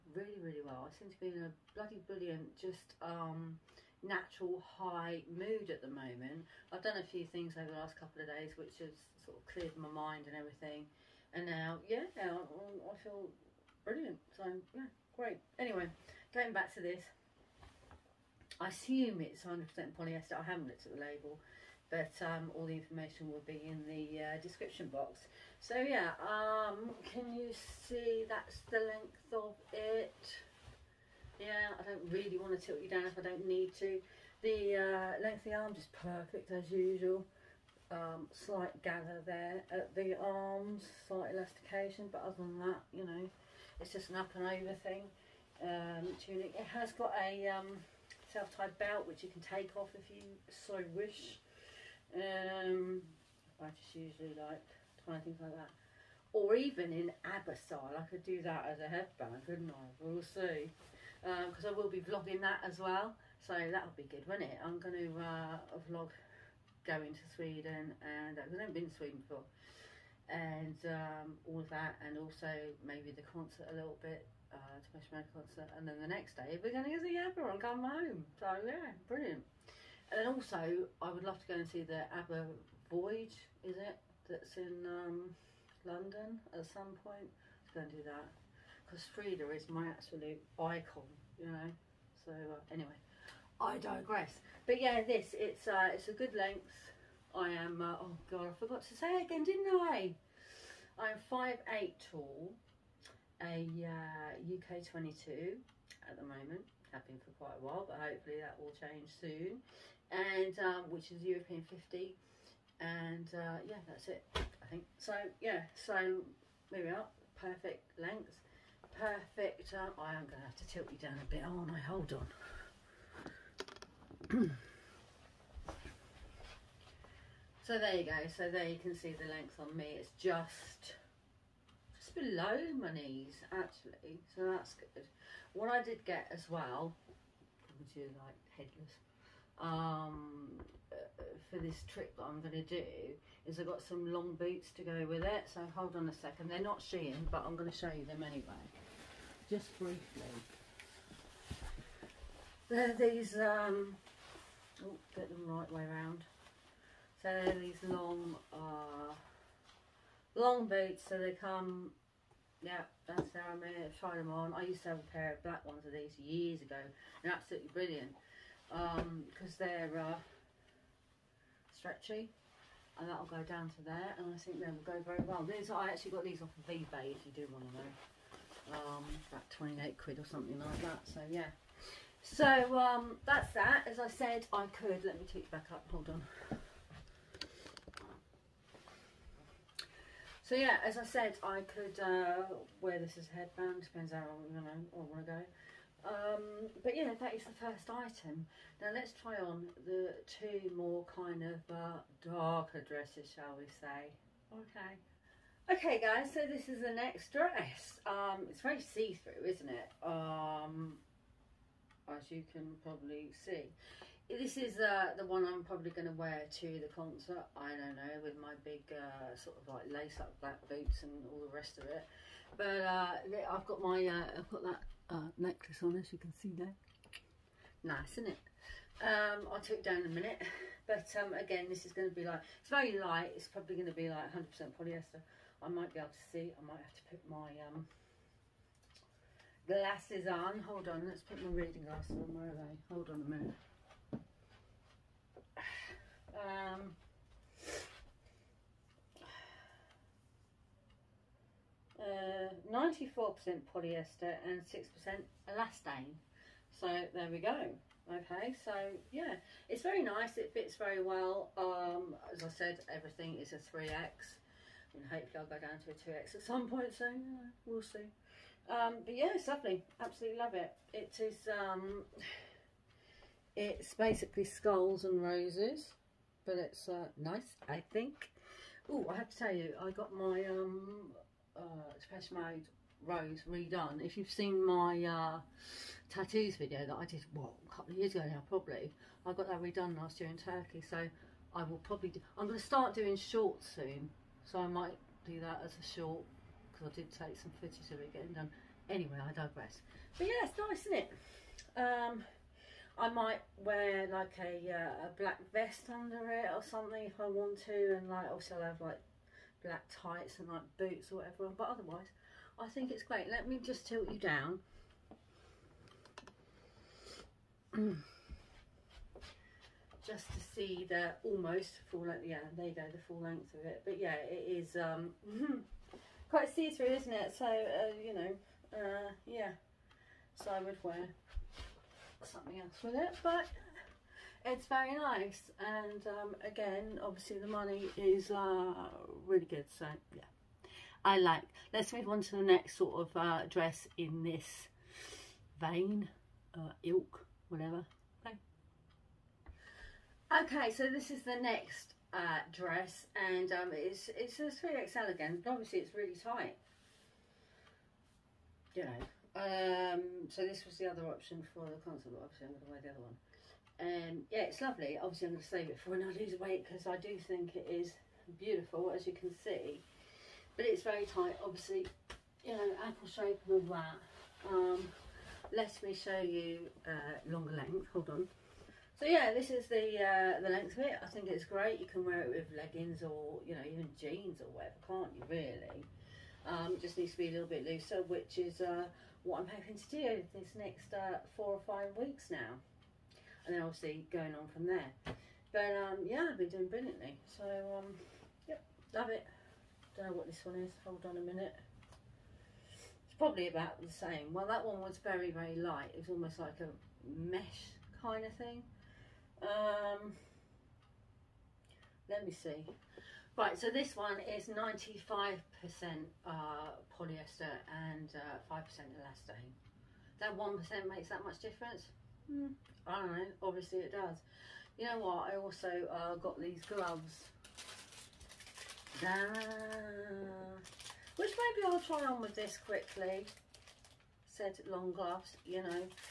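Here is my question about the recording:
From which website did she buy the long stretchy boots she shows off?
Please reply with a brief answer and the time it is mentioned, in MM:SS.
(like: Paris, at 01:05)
eBay, at 02:56.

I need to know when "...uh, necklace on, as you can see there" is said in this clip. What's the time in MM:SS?
03:45.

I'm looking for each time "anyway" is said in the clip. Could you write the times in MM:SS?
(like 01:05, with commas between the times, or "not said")
00:15, 01:32, 02:28, 04:58.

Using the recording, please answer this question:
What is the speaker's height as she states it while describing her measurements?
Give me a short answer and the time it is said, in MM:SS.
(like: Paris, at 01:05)
5 ft 8, at 01:41.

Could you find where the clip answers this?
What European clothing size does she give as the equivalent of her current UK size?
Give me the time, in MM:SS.
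01:51.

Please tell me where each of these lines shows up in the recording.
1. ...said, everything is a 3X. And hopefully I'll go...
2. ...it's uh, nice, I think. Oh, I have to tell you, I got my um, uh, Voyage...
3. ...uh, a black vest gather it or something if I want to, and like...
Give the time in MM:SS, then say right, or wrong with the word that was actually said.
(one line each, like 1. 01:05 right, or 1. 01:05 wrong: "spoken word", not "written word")
1. 04:22 right
2. 04:36 wrong: "Made", not "Voyage"
3. 05:04 wrong: "under", not "gather".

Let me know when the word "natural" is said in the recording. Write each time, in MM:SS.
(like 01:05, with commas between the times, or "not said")
00:04.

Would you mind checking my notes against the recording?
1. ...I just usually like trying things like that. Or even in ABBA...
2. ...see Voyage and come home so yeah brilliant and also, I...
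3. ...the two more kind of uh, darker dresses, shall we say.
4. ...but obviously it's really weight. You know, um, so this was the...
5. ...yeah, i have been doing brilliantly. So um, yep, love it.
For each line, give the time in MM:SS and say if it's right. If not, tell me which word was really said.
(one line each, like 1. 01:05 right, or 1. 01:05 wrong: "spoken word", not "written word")
1. 00:53 right
2. 01:17 wrong: "Abba", not "Voyage"
3. 03:19 right
4. 05:55 wrong: "tight", not "weight"
5. 06:36 right.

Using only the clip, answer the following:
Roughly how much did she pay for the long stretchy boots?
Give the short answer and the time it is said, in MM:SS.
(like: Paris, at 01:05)
£28, at 02:59.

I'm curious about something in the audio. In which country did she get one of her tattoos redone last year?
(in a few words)
Turkey.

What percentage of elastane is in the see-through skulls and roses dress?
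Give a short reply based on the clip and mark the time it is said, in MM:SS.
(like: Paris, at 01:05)
6%, at 04:14.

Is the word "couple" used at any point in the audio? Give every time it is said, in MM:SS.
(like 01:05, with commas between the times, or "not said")
00:07, 04:47.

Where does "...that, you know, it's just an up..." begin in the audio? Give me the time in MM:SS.
00:42.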